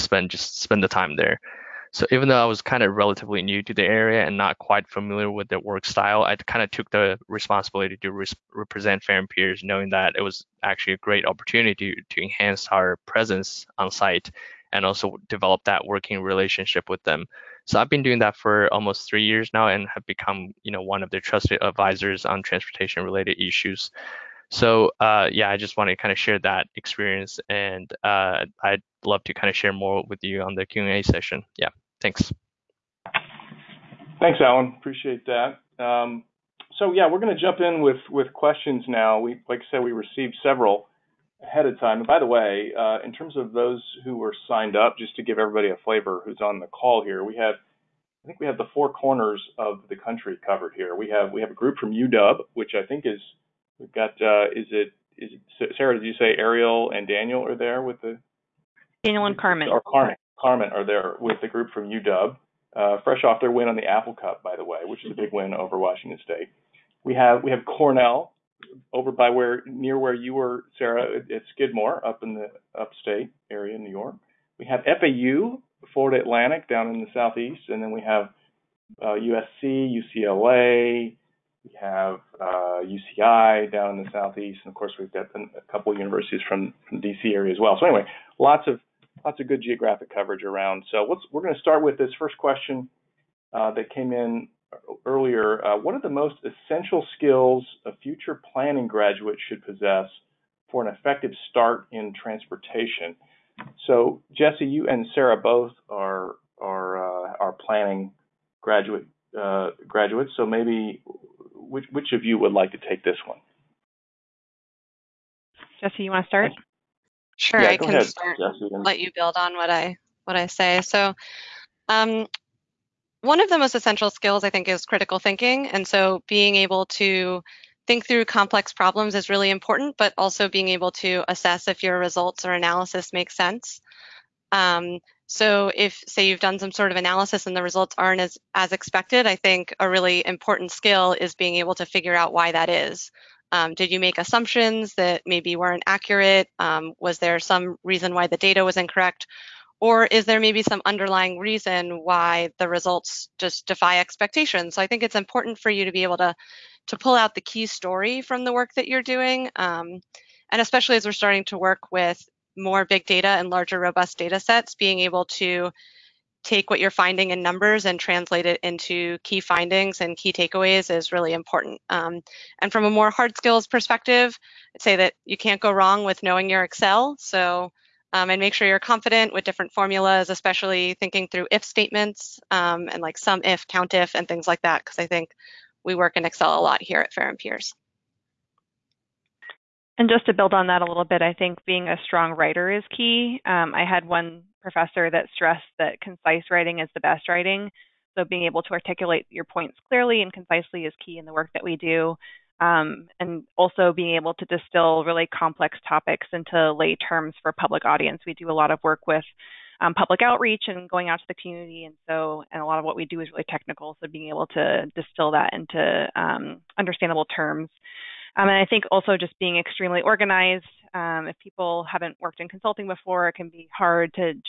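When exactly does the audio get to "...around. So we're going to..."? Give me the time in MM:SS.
01:30.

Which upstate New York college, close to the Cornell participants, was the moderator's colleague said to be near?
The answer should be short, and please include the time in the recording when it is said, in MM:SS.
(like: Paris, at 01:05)
Skidmore, at 01:11.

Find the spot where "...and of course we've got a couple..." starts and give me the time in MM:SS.
01:24.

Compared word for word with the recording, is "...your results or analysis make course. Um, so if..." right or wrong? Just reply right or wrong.
wrong.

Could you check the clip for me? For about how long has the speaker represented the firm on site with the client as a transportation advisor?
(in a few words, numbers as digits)
almost 3 years.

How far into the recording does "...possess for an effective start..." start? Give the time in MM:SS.
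01:39.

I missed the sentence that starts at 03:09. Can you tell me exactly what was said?
And just to build on that a little bit, I think being a strong writer is key.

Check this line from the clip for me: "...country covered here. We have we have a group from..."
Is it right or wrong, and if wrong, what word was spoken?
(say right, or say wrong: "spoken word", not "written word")
right.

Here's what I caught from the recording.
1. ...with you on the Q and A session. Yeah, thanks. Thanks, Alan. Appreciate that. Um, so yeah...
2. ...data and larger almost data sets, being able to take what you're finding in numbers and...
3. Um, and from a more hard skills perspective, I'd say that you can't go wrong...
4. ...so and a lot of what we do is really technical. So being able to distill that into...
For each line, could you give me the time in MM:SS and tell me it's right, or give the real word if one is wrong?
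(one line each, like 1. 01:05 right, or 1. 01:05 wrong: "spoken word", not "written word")
1. 00:30 right
2. 02:43 wrong: "robust", not "almost"
3. 02:51 right
4. 03:32 right.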